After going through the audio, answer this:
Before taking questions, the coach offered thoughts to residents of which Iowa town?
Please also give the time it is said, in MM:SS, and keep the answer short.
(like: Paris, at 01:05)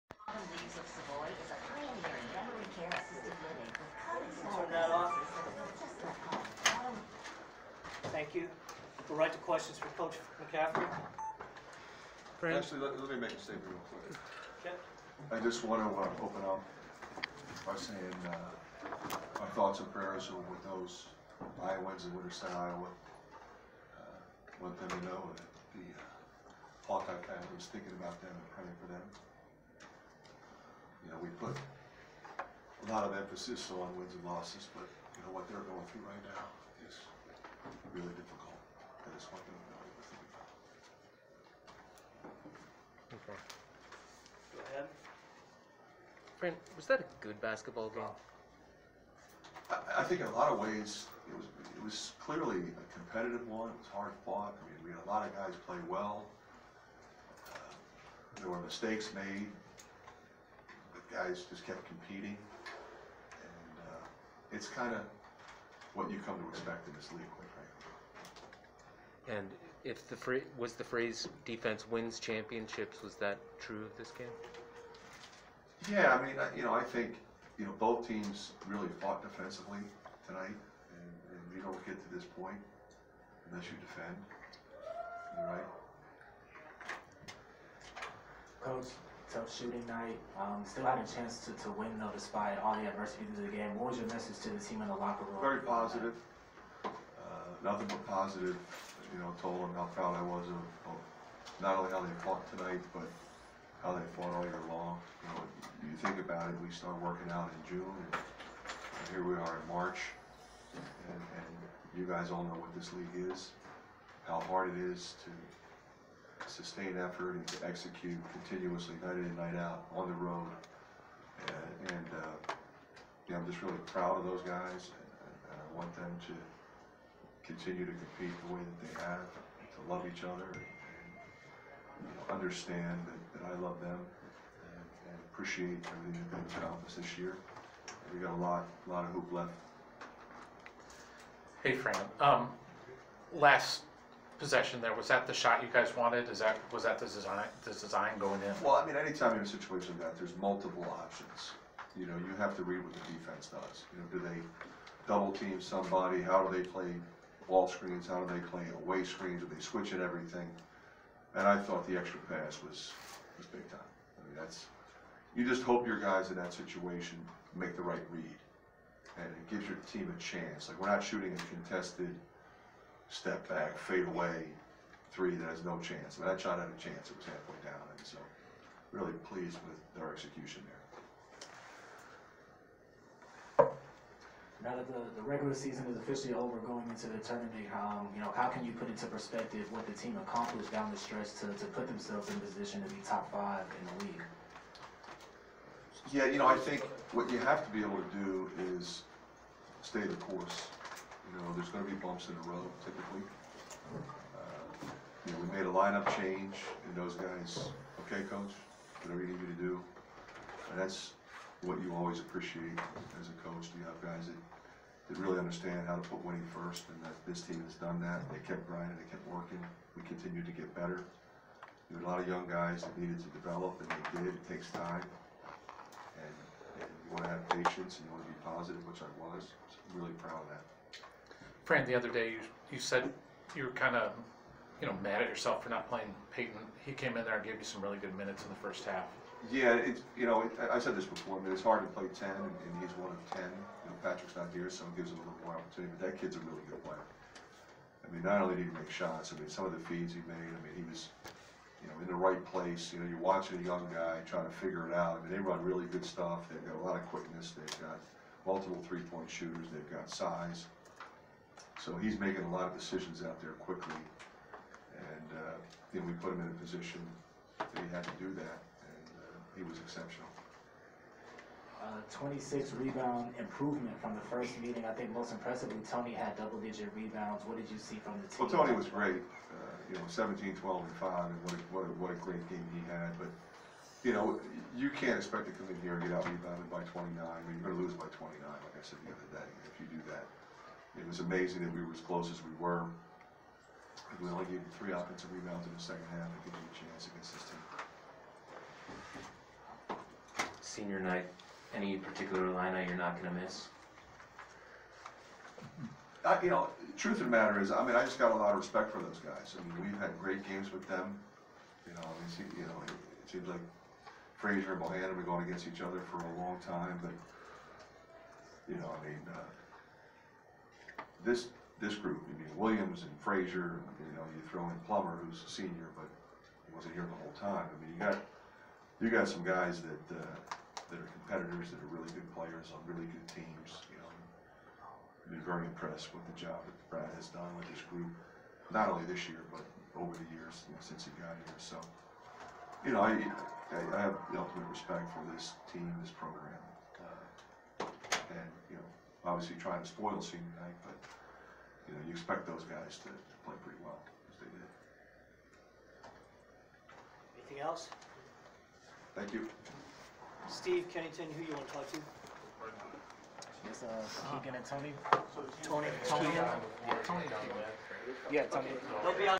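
Winterset, at 00:22.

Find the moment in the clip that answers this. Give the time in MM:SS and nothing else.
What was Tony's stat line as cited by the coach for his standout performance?
04:40.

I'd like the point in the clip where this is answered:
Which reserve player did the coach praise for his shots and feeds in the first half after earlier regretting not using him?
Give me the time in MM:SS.
03:56.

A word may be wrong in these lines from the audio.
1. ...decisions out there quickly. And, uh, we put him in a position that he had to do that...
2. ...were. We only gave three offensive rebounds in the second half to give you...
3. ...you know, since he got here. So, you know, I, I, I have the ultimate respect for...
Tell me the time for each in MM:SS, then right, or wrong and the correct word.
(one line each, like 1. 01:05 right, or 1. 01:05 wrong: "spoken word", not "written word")
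1. 04:22 right
2. 04:52 right
3. 05:40 right.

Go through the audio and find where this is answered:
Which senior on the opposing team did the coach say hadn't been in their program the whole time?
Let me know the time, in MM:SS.
05:24.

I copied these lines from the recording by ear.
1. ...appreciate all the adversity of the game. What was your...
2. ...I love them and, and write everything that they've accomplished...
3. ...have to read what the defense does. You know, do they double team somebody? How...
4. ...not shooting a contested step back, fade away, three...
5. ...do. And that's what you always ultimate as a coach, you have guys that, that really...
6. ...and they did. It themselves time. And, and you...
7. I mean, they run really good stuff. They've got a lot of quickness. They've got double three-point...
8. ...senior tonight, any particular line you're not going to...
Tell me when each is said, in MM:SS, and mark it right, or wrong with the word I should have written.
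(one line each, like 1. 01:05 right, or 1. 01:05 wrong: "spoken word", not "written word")
1. 01:32 wrong: "despite", not "appreciate"
2. 02:13 wrong: "appreciate", not "write"
3. 02:32 right
4. 02:50 right
5. 03:29 wrong: "appreciate", not "ultimate"
6. 03:43 wrong: "takes", not "themselves"
7. 04:15 wrong: "multiple", not "double"
8. 05:00 wrong: "night", not "tonight".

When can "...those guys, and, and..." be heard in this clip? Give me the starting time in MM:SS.
02:04.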